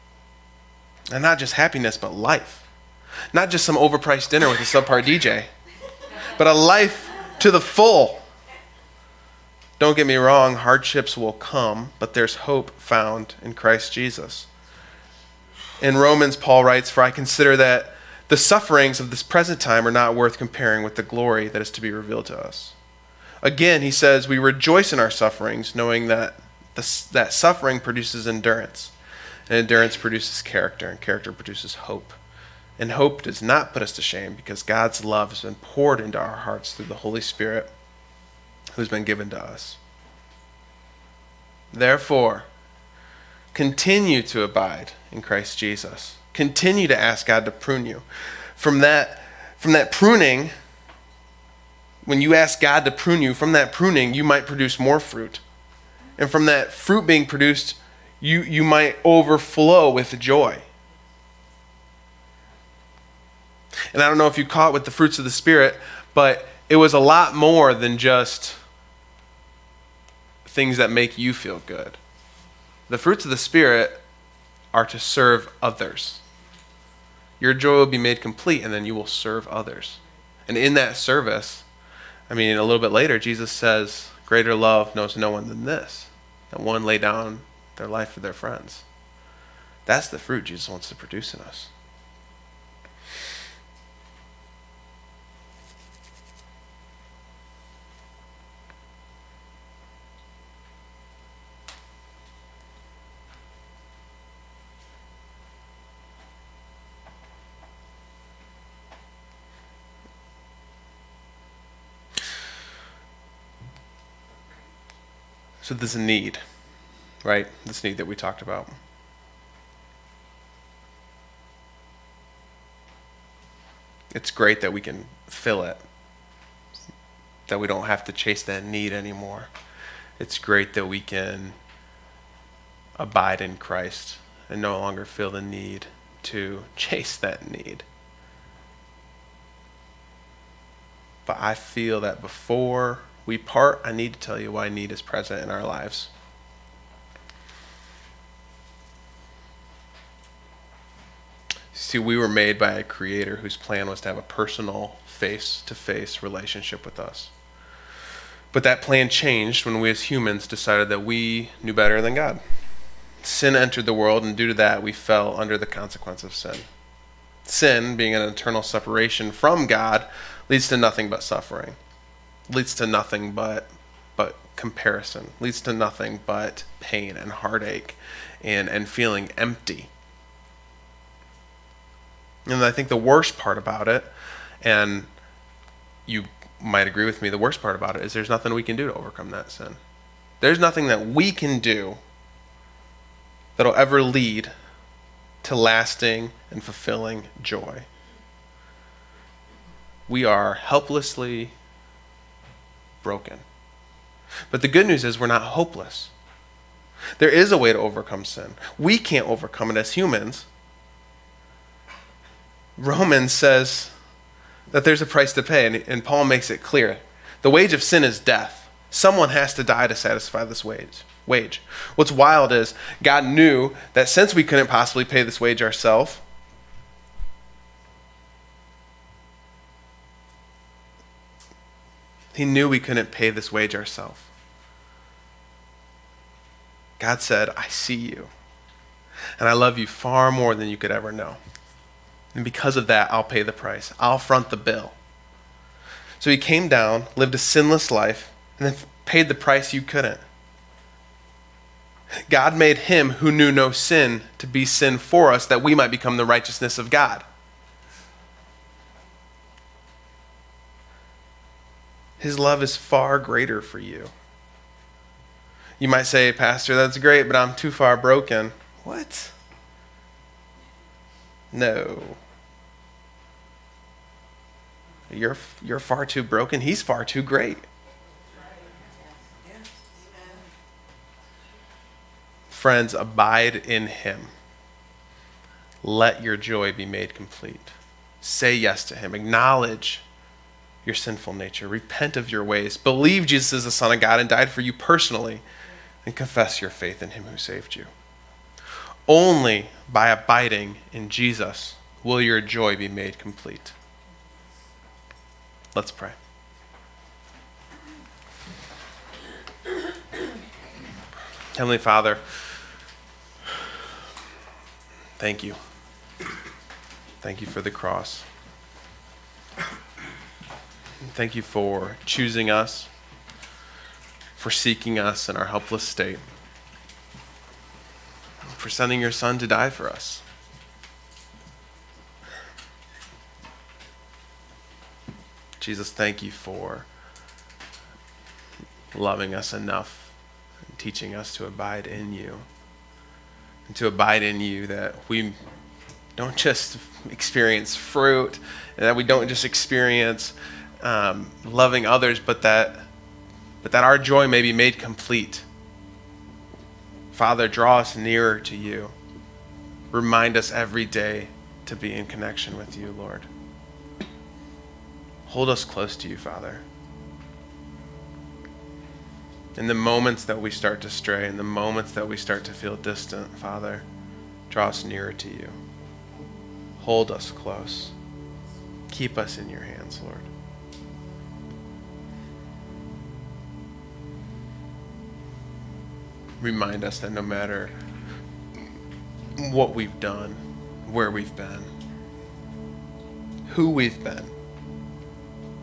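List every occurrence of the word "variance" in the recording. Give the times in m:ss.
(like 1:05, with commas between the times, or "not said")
not said.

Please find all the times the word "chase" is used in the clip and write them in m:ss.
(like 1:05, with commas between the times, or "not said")
2:08, 2:16.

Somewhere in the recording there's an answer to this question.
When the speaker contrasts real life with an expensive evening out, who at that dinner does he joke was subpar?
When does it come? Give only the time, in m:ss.
0:05.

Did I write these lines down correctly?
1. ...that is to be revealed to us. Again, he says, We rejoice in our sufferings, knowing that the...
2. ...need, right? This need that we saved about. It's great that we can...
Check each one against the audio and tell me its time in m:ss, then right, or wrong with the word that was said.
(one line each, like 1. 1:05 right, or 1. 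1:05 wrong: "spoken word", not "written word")
1. 0:21 right
2. 1:55 wrong: "talked", not "saved".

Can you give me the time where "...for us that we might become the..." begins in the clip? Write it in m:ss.
4:14.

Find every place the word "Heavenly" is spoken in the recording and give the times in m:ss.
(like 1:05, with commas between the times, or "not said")
5:11.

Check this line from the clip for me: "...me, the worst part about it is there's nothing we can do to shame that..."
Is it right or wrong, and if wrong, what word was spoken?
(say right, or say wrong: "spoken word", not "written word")
wrong: "overcome", not "shame".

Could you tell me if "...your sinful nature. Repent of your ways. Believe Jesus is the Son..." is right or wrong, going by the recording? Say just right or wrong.
right.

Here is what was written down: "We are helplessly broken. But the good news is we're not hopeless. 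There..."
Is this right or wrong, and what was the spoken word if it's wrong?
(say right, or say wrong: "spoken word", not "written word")
right.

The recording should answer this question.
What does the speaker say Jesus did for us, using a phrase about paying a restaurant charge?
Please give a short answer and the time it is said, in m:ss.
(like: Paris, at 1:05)
front the bill, at 4:04.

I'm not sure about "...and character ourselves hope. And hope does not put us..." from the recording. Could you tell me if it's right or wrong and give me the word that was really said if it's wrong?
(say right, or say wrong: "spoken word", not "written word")
wrong: "produces", not "ourselves".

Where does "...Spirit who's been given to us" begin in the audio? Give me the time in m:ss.
0:37.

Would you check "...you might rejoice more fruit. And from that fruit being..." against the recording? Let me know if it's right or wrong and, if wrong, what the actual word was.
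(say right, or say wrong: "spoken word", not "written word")
wrong: "produce", not "rejoice".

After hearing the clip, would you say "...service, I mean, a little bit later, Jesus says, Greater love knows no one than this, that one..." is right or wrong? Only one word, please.
right.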